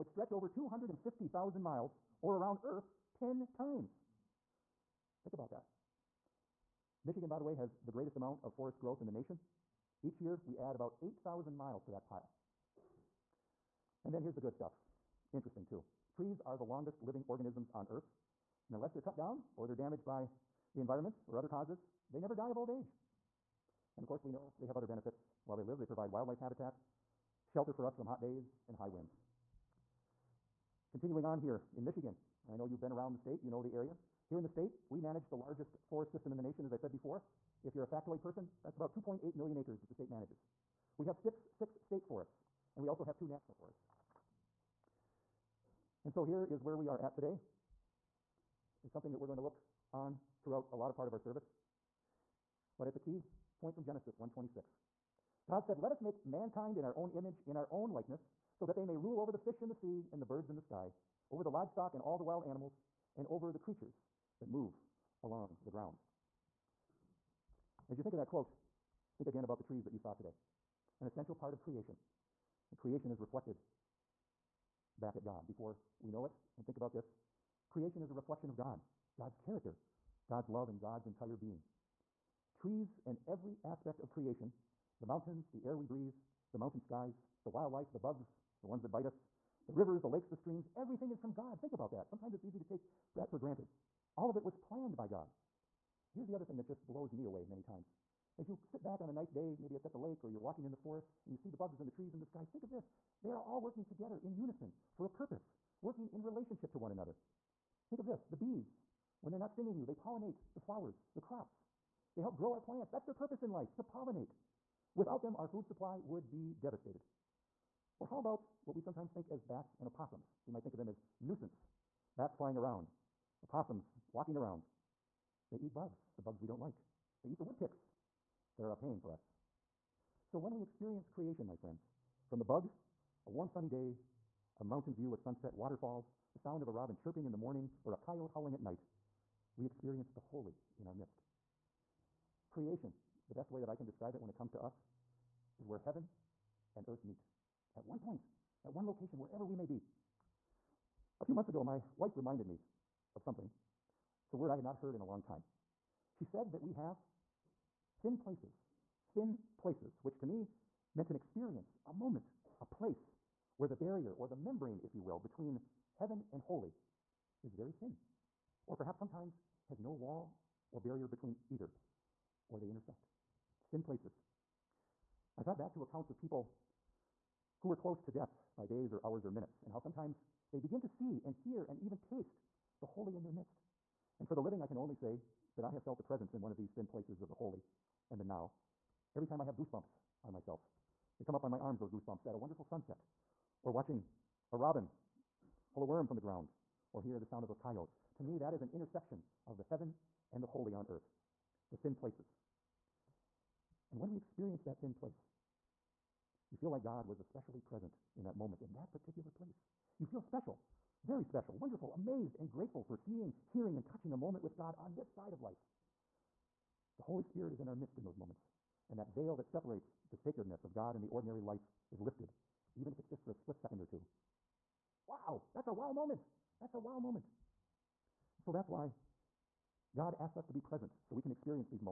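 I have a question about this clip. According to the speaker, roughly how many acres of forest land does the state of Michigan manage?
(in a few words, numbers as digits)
2.8 million acres.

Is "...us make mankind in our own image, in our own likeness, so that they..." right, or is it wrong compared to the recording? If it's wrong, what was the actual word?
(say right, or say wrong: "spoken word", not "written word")
right.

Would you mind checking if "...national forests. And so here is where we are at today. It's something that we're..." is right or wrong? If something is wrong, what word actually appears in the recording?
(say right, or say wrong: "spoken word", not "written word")
right.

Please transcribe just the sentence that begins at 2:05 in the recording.
They eat bugs, the bugs we don't like.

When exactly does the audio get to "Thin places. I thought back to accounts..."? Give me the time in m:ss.
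2:53.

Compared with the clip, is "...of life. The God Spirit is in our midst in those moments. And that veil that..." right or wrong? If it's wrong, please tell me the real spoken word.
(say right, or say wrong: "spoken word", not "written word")
wrong: "Holy", not "God".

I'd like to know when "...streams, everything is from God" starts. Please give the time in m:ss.
1:30.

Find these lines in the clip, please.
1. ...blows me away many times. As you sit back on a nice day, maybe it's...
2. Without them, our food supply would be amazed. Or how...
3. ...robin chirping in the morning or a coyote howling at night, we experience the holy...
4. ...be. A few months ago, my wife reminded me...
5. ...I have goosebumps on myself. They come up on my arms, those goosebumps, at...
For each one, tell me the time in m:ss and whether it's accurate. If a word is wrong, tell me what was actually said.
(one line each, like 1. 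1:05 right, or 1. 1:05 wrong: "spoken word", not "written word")
1. 1:36 right
2. 1:54 wrong: "devastated", not "amazed"
3. 2:16 right
4. 2:29 right
5. 3:09 right.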